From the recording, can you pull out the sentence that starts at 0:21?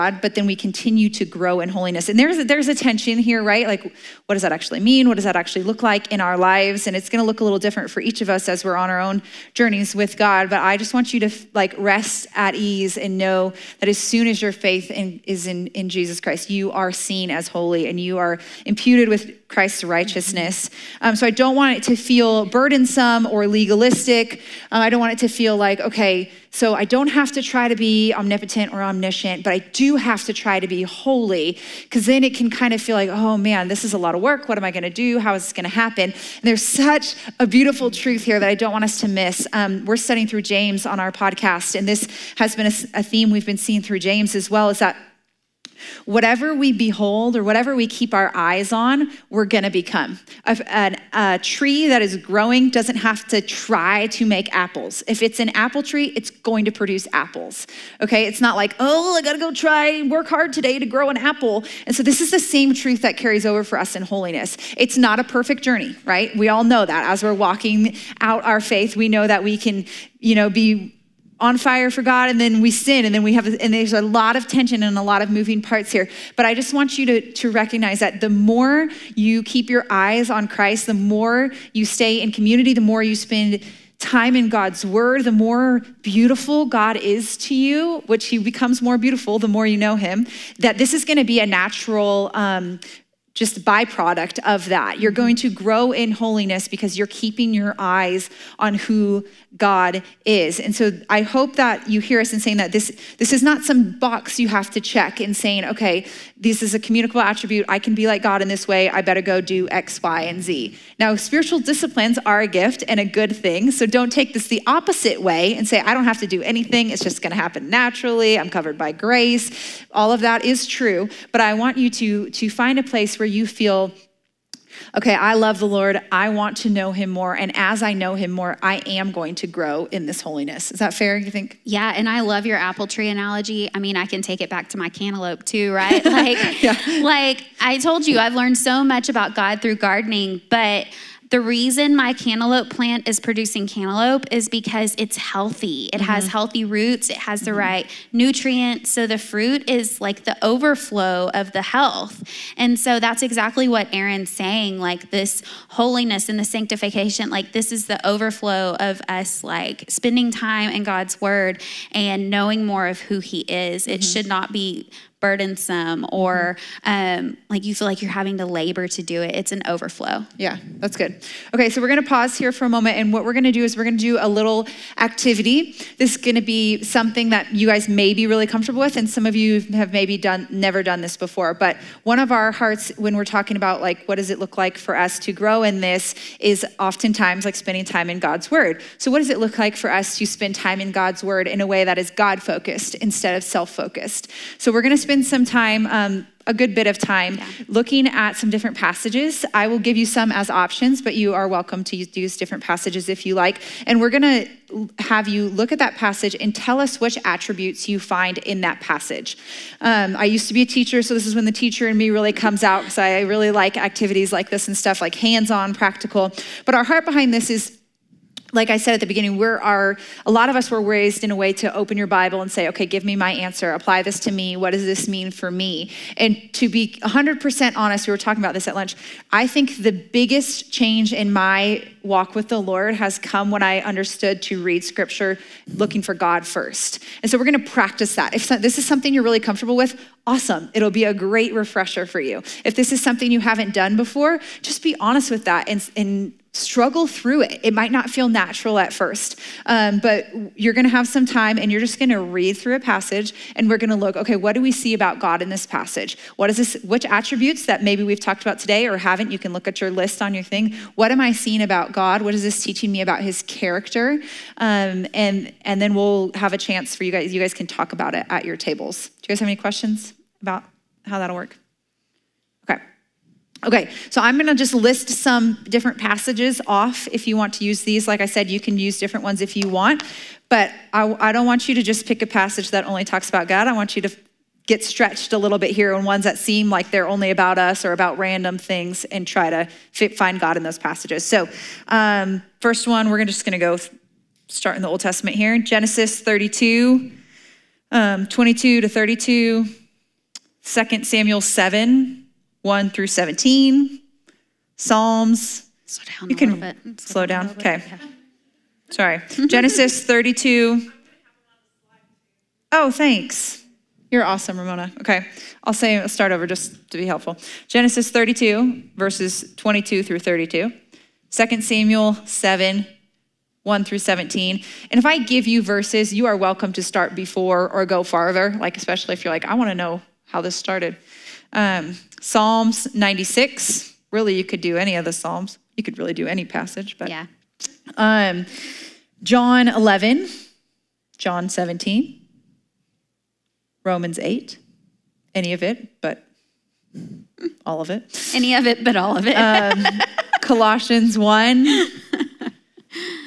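Um, so I don't want it to feel burdensome or legalistic.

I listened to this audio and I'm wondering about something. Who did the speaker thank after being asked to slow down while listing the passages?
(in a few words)
Ramona.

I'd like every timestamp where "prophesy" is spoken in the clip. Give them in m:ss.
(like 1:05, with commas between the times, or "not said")
not said.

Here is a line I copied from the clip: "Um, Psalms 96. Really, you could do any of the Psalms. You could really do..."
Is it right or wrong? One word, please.
right.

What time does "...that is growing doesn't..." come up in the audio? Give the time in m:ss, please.
0:51.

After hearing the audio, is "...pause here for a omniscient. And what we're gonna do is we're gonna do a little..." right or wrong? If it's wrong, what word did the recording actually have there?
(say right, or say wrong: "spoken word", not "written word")
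wrong: "moment", not "omniscient".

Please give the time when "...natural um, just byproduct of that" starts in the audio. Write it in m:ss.
1:31.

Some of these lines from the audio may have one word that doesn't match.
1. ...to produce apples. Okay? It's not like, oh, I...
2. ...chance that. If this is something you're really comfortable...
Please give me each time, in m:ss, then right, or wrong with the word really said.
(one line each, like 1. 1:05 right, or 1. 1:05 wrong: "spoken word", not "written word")
1. 0:56 right
2. 3:57 wrong: "practice", not "chance".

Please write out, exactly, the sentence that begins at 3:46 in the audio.
And to be 100% honest, we were talking about this at lunch.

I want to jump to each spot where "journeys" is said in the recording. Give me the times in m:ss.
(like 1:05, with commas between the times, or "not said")
0:09, 1:05.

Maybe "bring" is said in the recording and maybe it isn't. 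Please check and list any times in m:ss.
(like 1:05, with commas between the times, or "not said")
not said.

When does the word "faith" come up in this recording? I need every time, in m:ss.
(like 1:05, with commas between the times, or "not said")
0:14, 1:08.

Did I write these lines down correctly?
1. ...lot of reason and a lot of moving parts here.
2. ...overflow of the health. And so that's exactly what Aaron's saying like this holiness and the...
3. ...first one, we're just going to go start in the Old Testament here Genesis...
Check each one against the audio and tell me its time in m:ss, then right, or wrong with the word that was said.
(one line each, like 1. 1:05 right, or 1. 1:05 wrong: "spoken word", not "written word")
1. 1:14 wrong: "tension", not "reason"
2. 2:30 right
3. 4:52 right.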